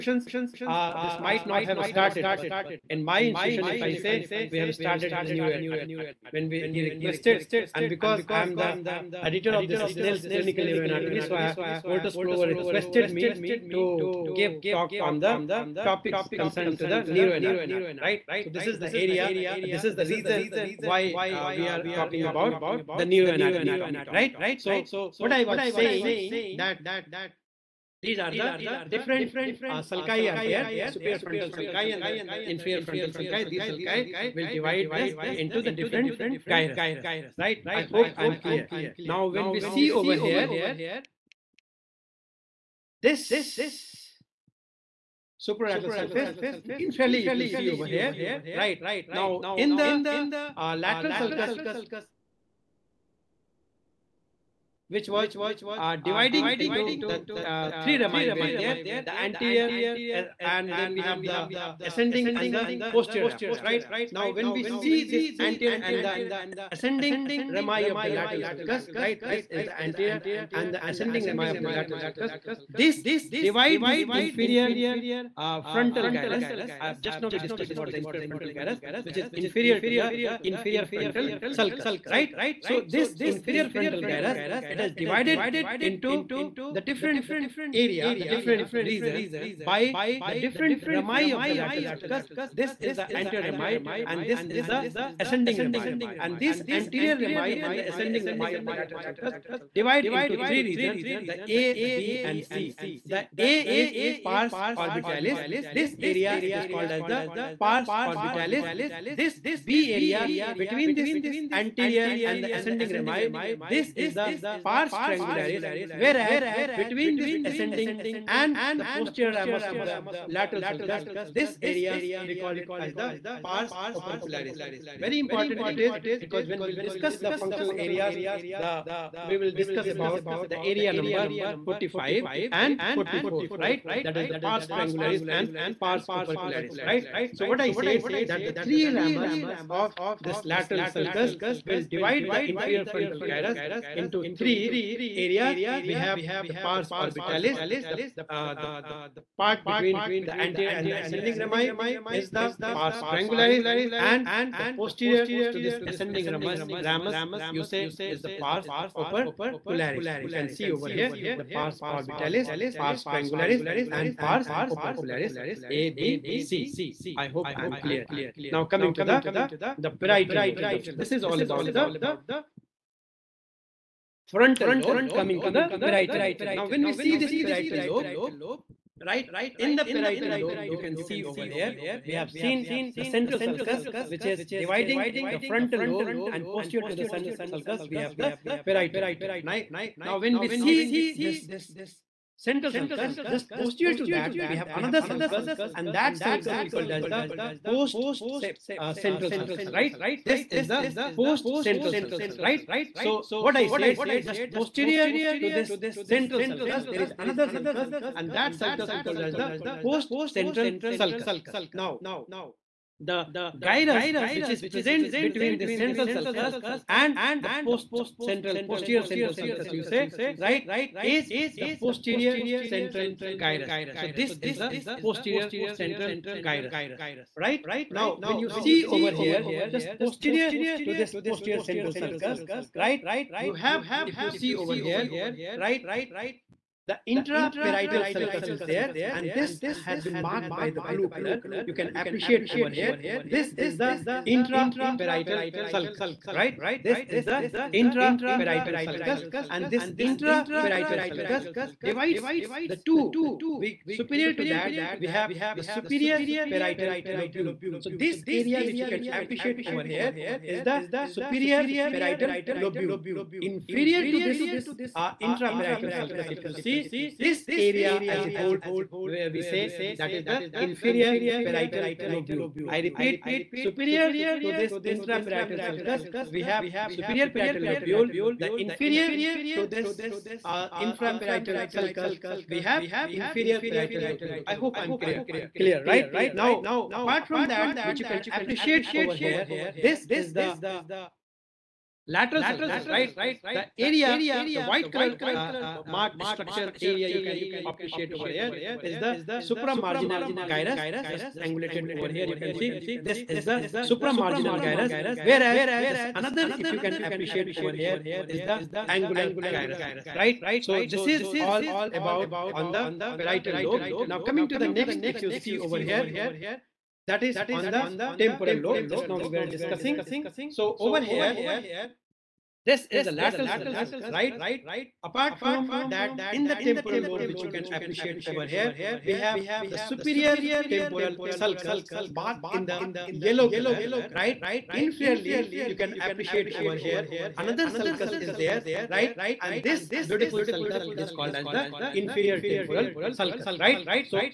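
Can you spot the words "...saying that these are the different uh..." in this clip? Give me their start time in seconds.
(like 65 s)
25 s.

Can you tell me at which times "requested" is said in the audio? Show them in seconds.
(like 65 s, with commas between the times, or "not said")
6 s, 12 s.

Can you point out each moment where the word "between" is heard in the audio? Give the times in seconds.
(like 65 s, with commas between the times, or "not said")
110 s, 116 s, 149 s, 215 s.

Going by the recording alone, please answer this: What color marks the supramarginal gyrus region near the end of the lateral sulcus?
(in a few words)
White.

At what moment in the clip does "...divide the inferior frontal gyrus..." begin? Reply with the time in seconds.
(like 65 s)
141 s.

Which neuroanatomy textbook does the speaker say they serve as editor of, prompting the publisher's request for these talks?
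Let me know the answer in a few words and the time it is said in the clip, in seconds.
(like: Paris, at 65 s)
Snell's Clinical Neuroanatomy, at 9 s.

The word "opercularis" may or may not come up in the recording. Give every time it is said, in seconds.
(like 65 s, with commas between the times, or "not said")
123 s, 136 s, 158 s, 164 s.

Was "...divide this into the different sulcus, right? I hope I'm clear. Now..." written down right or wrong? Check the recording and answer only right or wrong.
wrong.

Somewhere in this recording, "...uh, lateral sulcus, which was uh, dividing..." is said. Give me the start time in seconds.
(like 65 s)
50 s.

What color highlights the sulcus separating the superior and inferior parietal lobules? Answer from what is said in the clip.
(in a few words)
Blue.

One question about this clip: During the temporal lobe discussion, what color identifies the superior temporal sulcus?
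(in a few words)
Yellow.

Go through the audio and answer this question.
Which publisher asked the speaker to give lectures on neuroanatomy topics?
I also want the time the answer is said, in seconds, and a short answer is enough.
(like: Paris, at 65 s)
Wolters Kluwer, at 11 s.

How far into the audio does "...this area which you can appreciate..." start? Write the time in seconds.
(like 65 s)
257 s.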